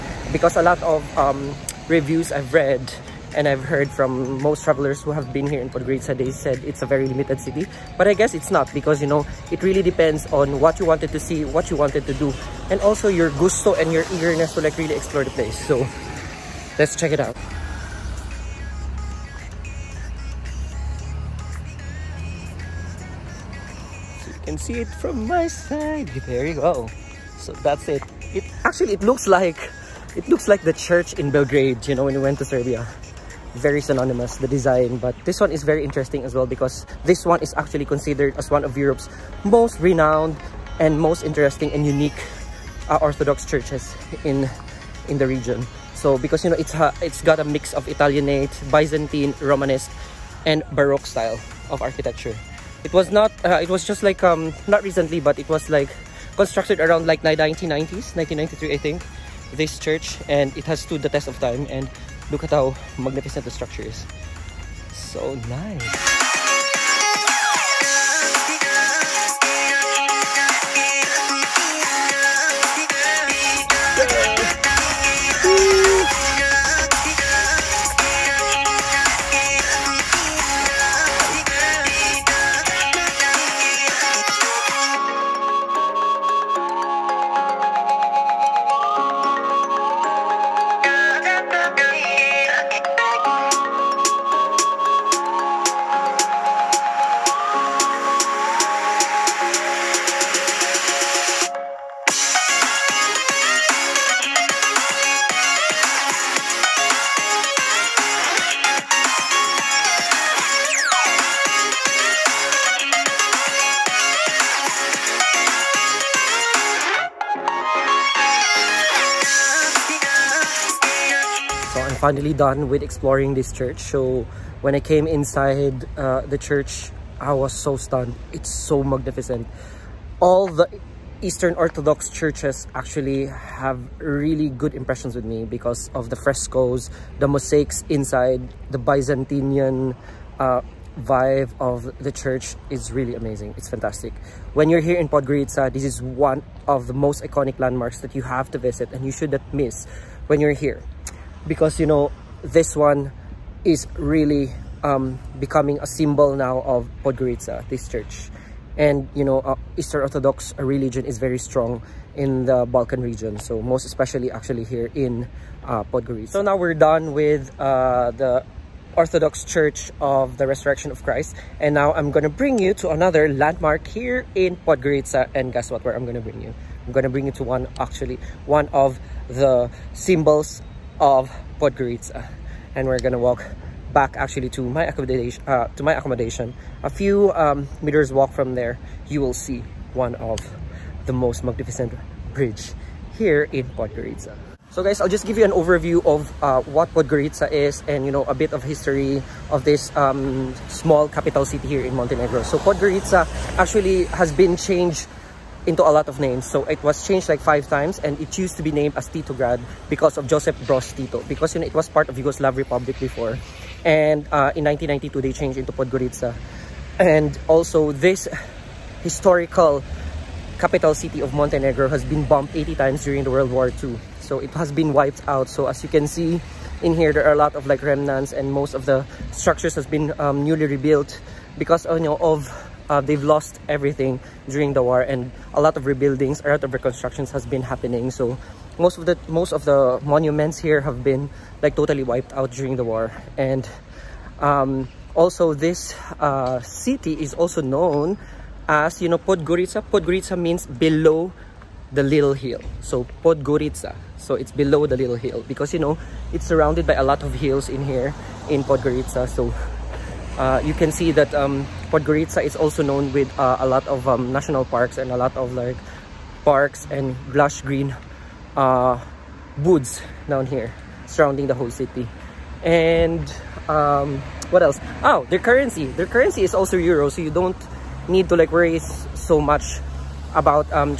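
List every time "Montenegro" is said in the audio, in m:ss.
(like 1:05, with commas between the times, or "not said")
3:21, 3:41.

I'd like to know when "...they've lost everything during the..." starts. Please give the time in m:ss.
3:53.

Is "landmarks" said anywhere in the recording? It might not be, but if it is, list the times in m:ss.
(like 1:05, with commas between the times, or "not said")
2:27, 2:53.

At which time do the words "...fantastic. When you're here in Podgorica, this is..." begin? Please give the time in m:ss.
2:23.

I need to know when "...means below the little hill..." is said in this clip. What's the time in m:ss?
4:10.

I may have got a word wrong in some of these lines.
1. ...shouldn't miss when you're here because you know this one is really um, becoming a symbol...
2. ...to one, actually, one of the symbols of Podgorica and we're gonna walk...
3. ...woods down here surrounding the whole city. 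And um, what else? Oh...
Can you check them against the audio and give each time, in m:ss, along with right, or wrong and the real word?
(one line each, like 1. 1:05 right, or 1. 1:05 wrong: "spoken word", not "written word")
1. 2:29 right
2. 2:57 right
3. 4:29 right.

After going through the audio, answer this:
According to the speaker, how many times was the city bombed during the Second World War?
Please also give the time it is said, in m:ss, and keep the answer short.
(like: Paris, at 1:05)
80, at 3:42.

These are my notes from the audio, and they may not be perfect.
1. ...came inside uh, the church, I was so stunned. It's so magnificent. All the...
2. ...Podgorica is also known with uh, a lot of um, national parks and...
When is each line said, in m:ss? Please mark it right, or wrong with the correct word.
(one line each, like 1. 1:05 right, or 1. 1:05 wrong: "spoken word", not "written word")
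1. 2:04 right
2. 4:21 right.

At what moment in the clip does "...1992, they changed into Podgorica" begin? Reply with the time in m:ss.
3:34.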